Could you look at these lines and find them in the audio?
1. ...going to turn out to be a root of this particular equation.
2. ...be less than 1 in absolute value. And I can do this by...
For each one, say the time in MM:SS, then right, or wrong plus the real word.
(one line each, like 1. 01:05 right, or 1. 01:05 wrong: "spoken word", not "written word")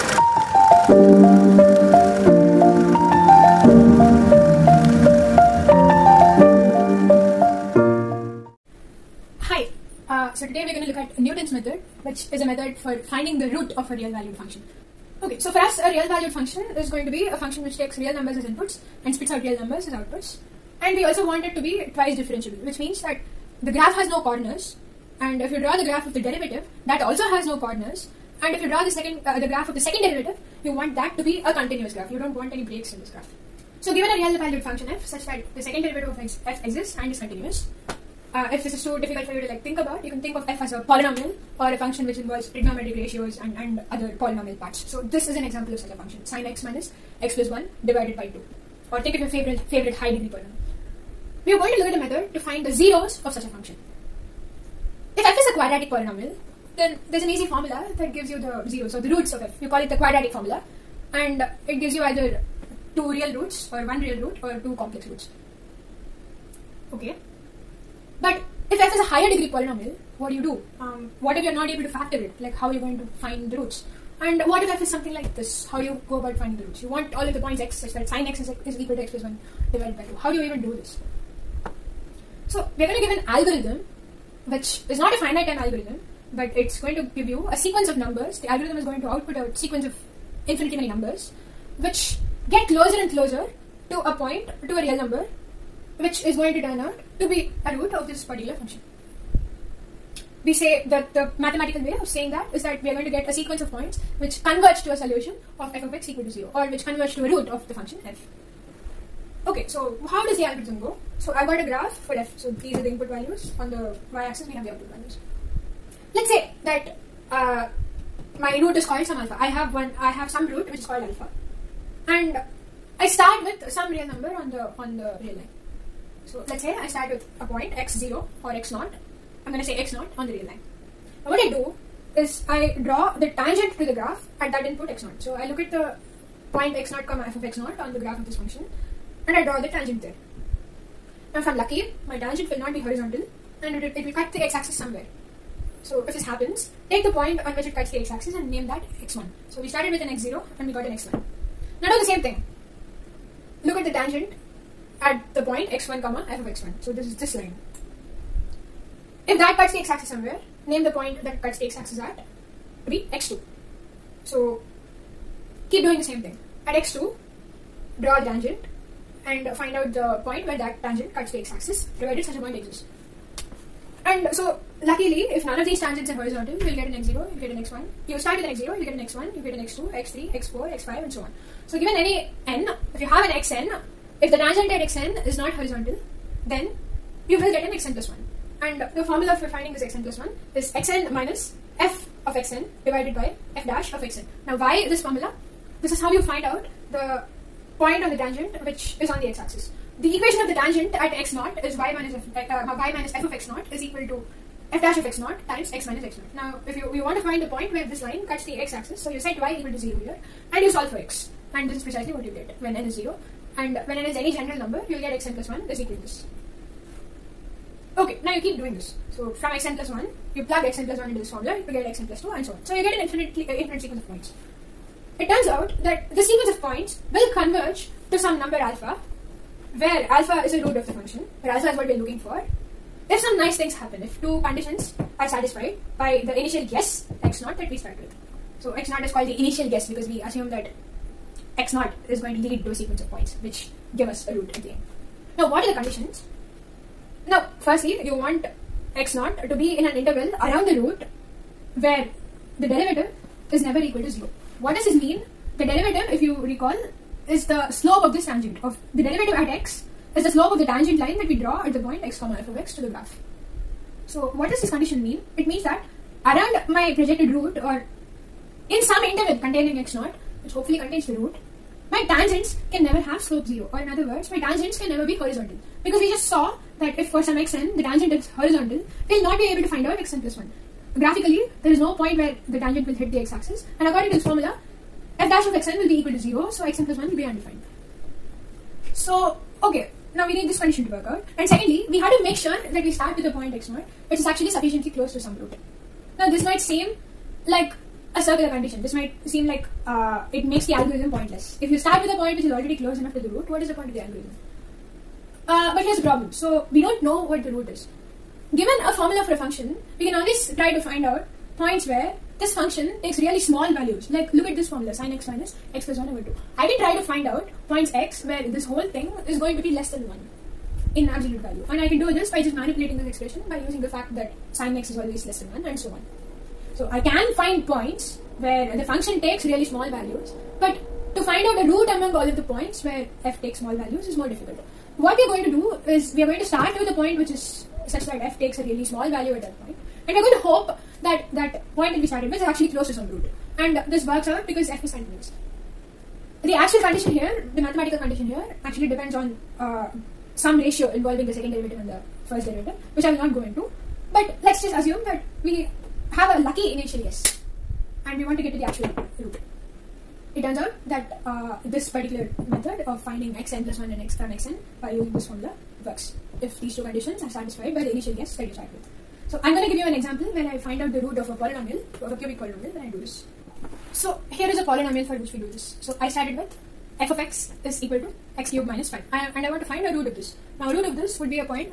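1. 01:36 wrong: "function", not "equation"
2. 05:19 right.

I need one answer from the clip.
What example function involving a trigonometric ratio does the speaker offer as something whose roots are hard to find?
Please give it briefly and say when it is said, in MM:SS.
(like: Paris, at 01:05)
sin x - (x+1)/2, at 00:46.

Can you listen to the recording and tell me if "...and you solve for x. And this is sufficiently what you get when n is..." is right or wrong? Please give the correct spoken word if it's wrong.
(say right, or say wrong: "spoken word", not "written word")
wrong: "precisely", not "sufficiently".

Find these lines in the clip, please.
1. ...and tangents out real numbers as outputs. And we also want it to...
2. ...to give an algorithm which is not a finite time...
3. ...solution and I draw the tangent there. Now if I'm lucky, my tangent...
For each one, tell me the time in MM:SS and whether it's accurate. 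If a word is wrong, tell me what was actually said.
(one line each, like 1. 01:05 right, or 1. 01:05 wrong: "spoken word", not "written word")
1. 00:19 wrong: "spits", not "tangents"
2. 01:22 right
3. 02:18 wrong: "function", not "solution".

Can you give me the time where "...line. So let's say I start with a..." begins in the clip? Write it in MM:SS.
02:05.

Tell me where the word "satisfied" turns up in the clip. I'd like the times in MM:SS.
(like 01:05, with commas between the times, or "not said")
03:55, 06:07.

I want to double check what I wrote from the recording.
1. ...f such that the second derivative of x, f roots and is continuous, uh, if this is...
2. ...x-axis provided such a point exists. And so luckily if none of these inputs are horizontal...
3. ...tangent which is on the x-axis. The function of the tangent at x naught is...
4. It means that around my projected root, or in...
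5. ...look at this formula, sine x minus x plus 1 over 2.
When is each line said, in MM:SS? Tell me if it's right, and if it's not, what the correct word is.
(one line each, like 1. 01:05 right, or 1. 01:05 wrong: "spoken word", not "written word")
1. 00:34 wrong: "exists", not "roots"
2. 02:51 wrong: "tangents", not "inputs"
3. 03:18 wrong: "equation", not "function"
4. 04:25 right
5. 05:14 right.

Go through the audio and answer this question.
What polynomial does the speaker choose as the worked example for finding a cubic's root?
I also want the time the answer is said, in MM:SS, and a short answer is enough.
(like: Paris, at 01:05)
x^3 - 5, at 06:18.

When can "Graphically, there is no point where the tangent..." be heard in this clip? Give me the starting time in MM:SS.
04:40.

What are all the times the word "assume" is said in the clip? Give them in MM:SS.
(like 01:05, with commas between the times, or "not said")
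04:00, 05:54.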